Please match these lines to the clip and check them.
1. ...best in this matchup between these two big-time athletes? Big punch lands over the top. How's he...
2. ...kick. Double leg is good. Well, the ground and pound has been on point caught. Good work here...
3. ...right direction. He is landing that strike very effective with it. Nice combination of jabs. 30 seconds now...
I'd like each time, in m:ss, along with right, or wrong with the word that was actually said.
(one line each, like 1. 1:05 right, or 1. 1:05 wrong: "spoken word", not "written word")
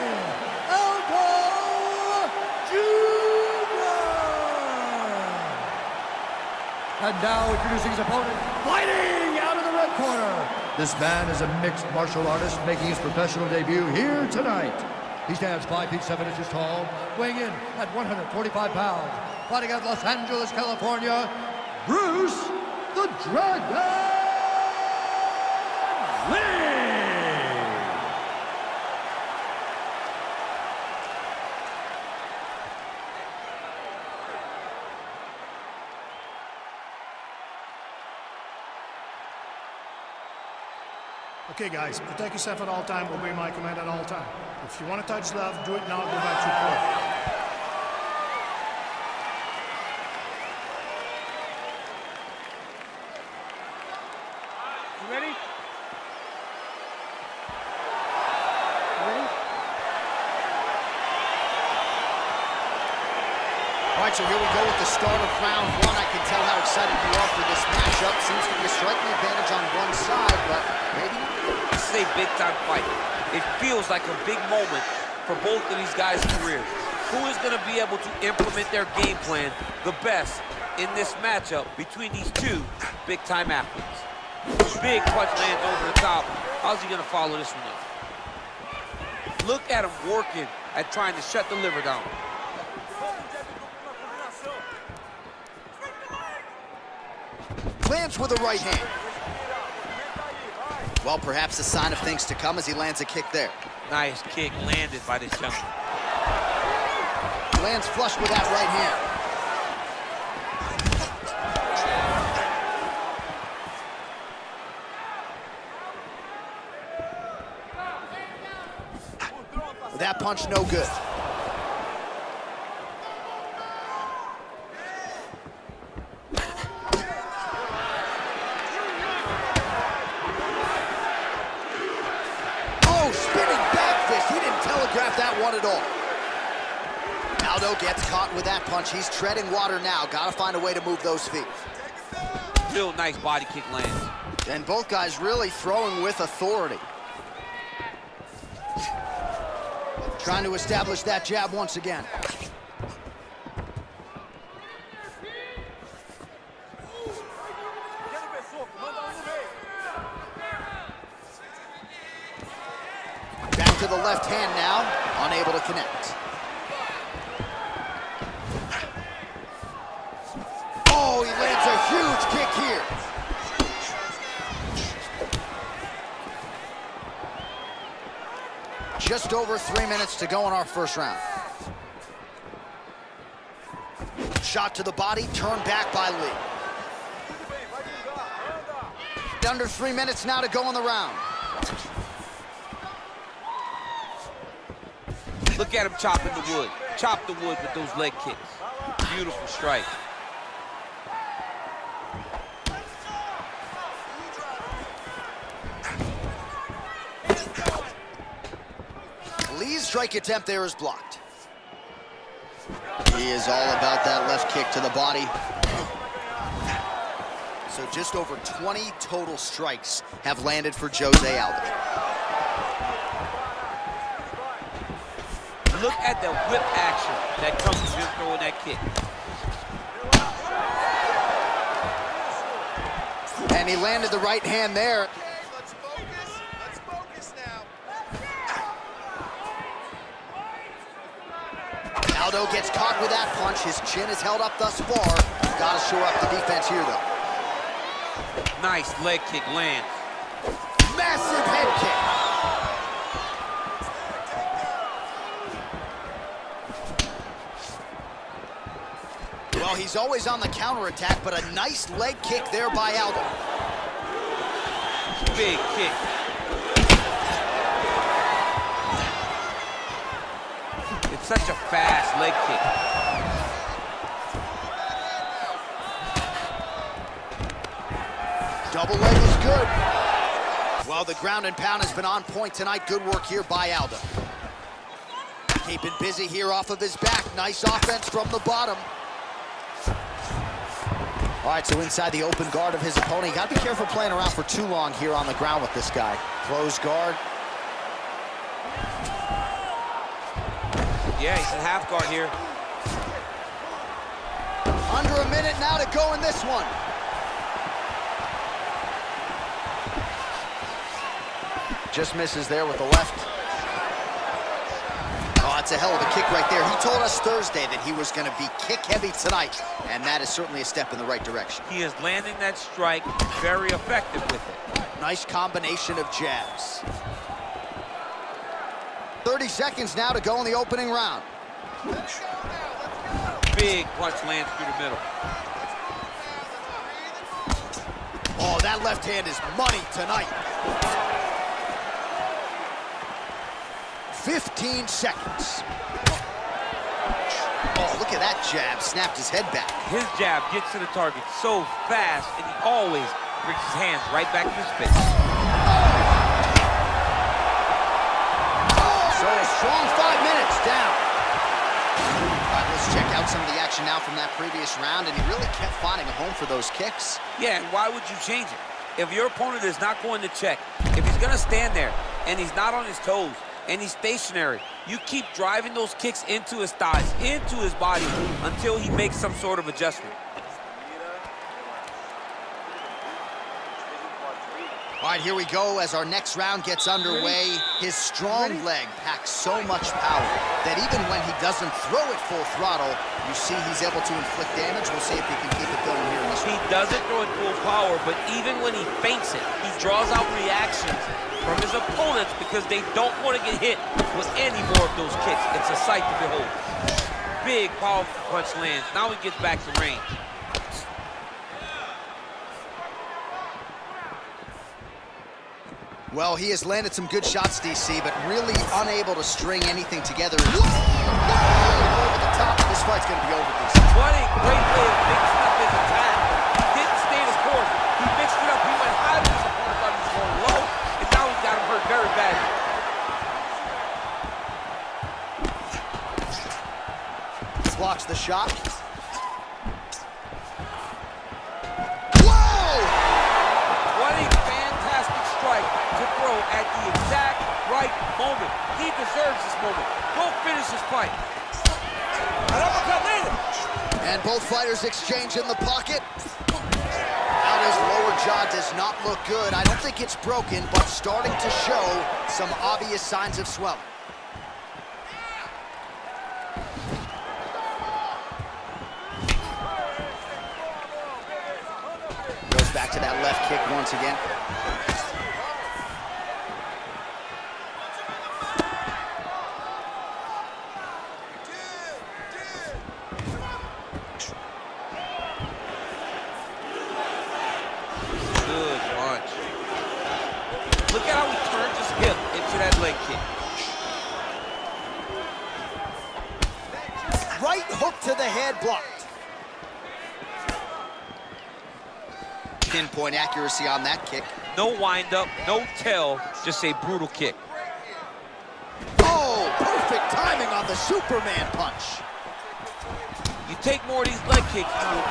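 1. 1:20 right
2. 4:32 wrong: "tonight", not "caught"
3. 5:21 right.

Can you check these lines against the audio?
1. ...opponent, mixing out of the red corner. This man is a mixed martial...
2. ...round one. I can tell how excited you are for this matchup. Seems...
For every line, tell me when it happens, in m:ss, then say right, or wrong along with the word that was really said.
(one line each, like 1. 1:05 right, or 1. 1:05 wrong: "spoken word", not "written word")
1. 0:07 wrong: "fighting", not "mixing"
2. 1:05 right.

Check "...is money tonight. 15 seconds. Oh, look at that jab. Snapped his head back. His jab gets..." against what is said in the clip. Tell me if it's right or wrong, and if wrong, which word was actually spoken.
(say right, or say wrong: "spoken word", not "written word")
right.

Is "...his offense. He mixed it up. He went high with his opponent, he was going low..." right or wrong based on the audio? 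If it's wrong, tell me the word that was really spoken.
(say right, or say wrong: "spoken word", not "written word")
wrong: "course", not "offense".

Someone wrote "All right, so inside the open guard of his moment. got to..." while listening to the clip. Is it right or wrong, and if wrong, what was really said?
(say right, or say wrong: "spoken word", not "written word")
wrong: "opponent", not "moment".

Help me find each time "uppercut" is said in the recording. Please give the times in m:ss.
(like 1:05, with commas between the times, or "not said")
7:32.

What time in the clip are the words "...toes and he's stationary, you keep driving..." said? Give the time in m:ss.
6:12.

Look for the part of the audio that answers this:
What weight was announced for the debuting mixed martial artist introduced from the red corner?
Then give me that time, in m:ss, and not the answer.
0:17.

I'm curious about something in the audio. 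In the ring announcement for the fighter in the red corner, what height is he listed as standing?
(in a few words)
5 feet 7 inches.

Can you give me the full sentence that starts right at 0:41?
Okay, guys, protect yourself at all time.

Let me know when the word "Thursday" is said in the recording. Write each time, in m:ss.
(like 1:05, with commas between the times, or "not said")
5:17.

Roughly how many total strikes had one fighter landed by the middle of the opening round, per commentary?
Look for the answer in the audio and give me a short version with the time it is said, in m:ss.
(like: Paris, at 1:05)
20, at 3:38.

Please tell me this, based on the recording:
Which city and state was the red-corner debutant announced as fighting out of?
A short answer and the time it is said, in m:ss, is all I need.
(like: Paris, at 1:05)
Los Angeles, California, at 0:19.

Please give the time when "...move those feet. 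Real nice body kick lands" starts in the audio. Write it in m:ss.
2:20.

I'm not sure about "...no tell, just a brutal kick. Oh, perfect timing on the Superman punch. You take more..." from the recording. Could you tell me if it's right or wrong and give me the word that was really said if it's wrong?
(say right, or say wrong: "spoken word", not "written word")
right.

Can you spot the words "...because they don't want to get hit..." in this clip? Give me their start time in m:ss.
6:42.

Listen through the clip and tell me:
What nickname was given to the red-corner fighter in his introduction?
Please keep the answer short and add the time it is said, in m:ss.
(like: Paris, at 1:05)
the Dragon, at 0:22.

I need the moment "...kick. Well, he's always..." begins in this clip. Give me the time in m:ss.
4:19.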